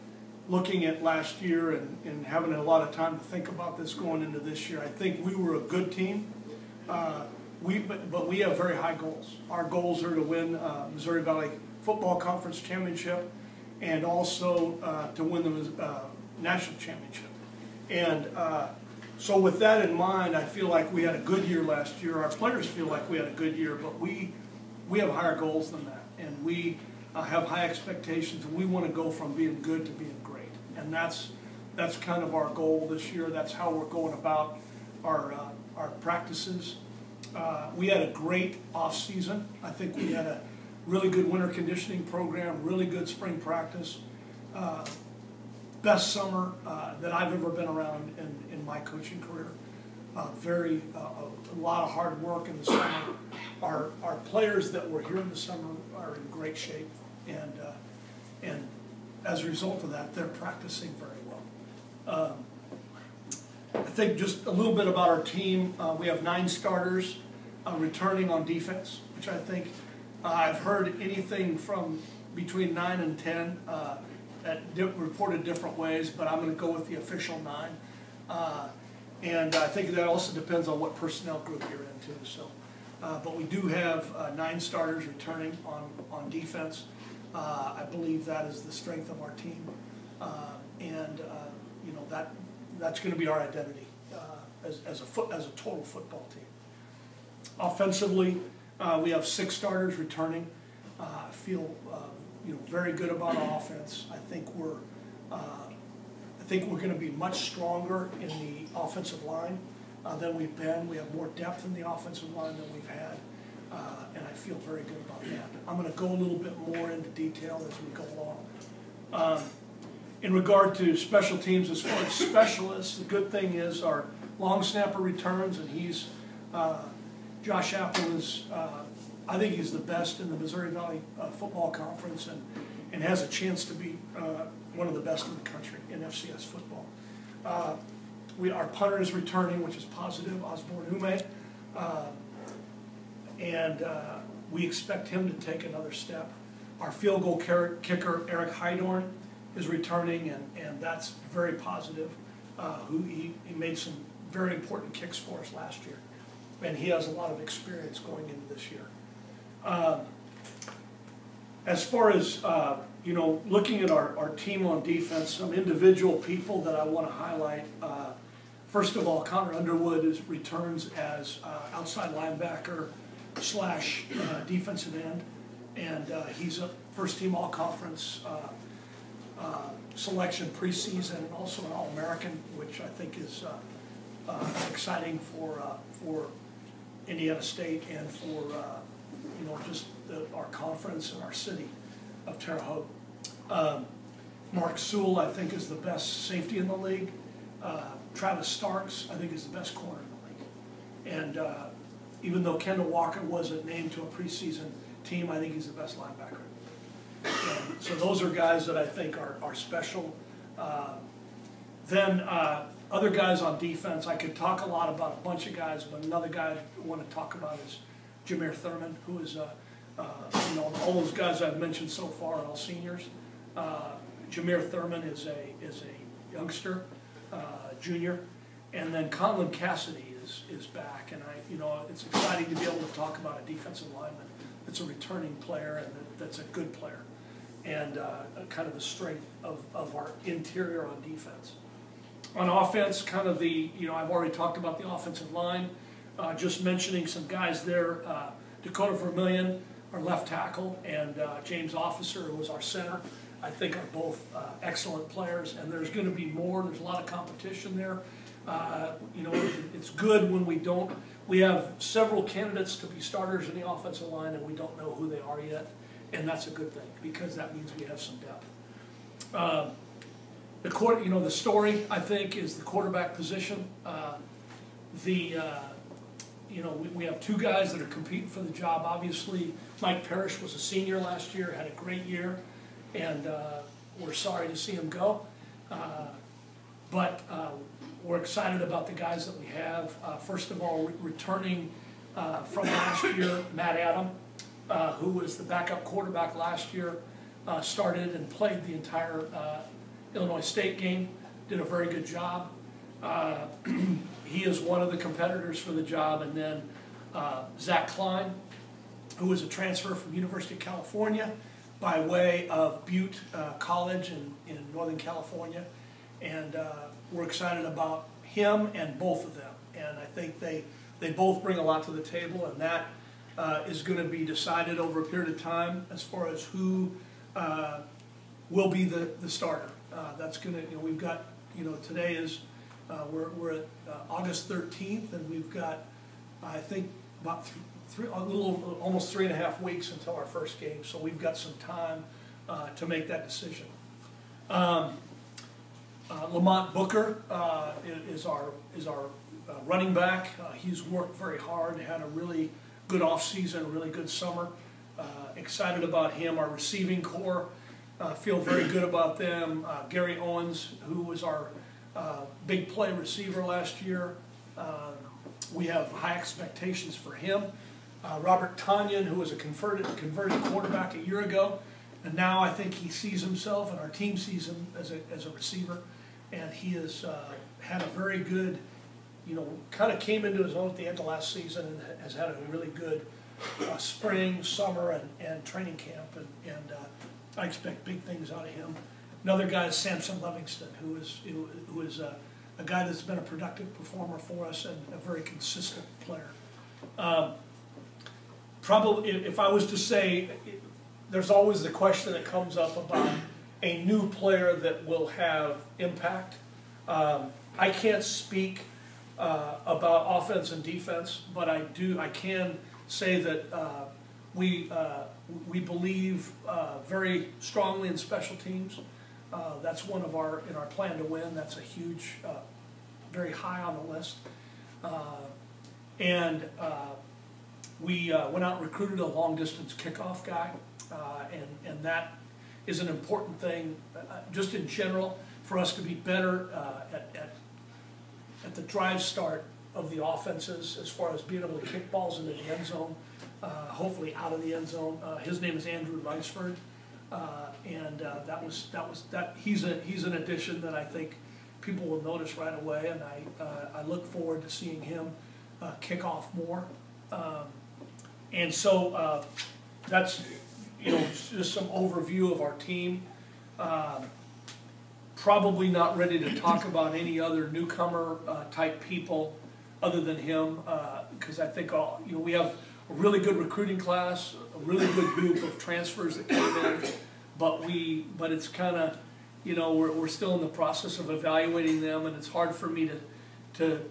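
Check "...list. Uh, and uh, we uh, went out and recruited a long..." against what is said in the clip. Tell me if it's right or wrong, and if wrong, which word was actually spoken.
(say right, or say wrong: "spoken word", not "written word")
right.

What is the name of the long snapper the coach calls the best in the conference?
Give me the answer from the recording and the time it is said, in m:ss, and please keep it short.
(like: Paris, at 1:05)
Josh Appel, at 2:07.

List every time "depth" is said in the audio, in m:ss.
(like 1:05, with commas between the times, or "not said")
1:51, 4:28.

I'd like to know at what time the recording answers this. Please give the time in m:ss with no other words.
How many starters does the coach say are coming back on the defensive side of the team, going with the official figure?
1:06.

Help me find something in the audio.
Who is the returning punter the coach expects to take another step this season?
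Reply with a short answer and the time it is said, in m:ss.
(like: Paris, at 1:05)
Osborne Hume, at 2:20.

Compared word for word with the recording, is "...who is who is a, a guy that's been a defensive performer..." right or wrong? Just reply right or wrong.
wrong.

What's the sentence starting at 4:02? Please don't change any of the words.
On offense, kind of the, you know, I've already talked about the offensive line.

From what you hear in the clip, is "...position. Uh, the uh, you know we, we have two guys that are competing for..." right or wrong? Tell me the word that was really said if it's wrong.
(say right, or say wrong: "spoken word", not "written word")
right.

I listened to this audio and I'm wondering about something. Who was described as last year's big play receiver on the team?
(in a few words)
Gary Owens.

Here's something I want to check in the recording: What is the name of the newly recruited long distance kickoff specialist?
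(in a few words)
Andrew Lunsford.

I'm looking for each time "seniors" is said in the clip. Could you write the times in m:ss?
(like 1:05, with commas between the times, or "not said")
3:42, 4:40.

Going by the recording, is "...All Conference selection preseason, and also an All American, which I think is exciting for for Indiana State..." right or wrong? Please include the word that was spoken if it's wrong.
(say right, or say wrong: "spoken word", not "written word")
right.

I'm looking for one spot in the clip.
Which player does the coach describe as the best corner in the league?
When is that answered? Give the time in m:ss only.
3:18.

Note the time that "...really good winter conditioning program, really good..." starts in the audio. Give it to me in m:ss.
0:40.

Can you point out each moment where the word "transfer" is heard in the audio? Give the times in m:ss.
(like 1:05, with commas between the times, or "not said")
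5:09, 7:55.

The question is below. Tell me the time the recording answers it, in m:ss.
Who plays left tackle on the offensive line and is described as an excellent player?
4:08.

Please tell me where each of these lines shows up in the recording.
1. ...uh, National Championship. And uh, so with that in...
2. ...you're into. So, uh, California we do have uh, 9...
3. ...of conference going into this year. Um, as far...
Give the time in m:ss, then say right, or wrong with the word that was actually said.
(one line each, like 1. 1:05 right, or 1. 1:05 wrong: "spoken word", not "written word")
1. 0:15 right
2. 1:21 wrong: "But", not "California"
3. 2:37 wrong: "experience", not "conference".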